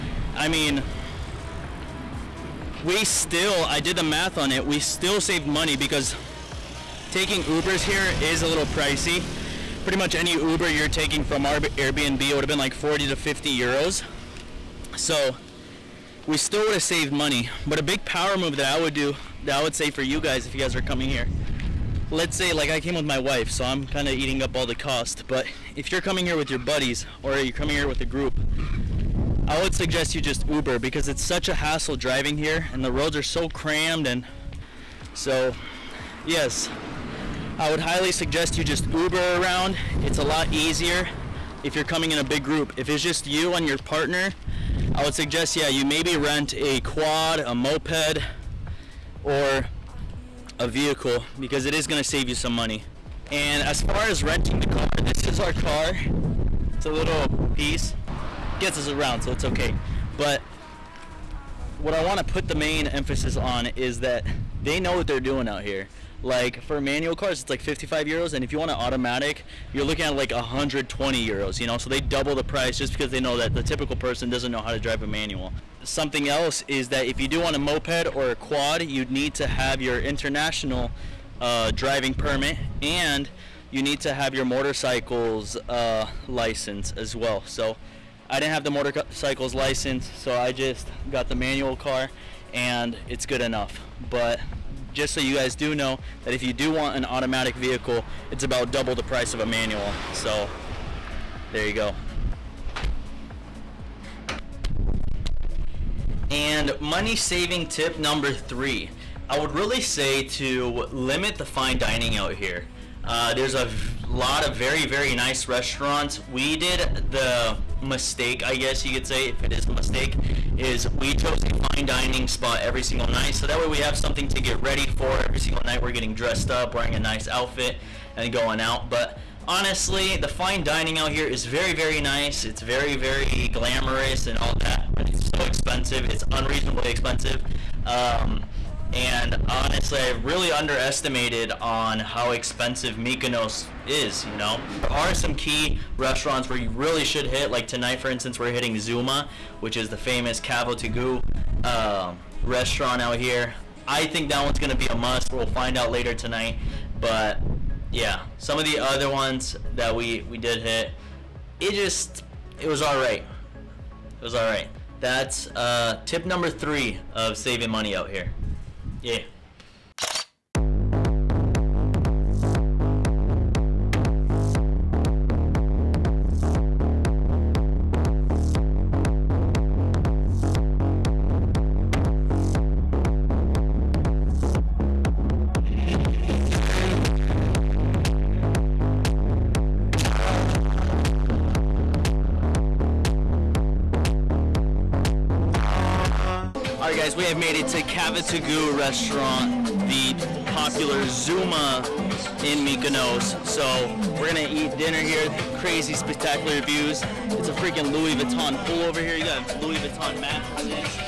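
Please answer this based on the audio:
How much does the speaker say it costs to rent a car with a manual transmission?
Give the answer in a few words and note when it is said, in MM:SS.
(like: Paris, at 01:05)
55 euros, at 01:07.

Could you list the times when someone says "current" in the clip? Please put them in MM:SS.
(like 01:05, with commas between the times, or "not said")
not said.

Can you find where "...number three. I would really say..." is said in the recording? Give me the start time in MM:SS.
01:48.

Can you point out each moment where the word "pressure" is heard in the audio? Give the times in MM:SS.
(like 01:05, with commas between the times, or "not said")
not said.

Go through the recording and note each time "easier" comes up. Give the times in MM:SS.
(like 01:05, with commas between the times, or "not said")
00:40.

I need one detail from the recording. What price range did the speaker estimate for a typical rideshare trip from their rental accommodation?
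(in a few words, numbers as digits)
40 to 50 euros.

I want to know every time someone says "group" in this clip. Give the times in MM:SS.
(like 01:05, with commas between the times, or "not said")
00:28, 00:42.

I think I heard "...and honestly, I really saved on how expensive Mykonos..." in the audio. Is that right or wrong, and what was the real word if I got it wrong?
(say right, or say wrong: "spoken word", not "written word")
wrong: "underestimated", not "saved".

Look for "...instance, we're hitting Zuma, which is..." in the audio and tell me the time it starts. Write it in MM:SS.
02:28.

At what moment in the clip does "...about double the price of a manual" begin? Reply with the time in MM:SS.
01:38.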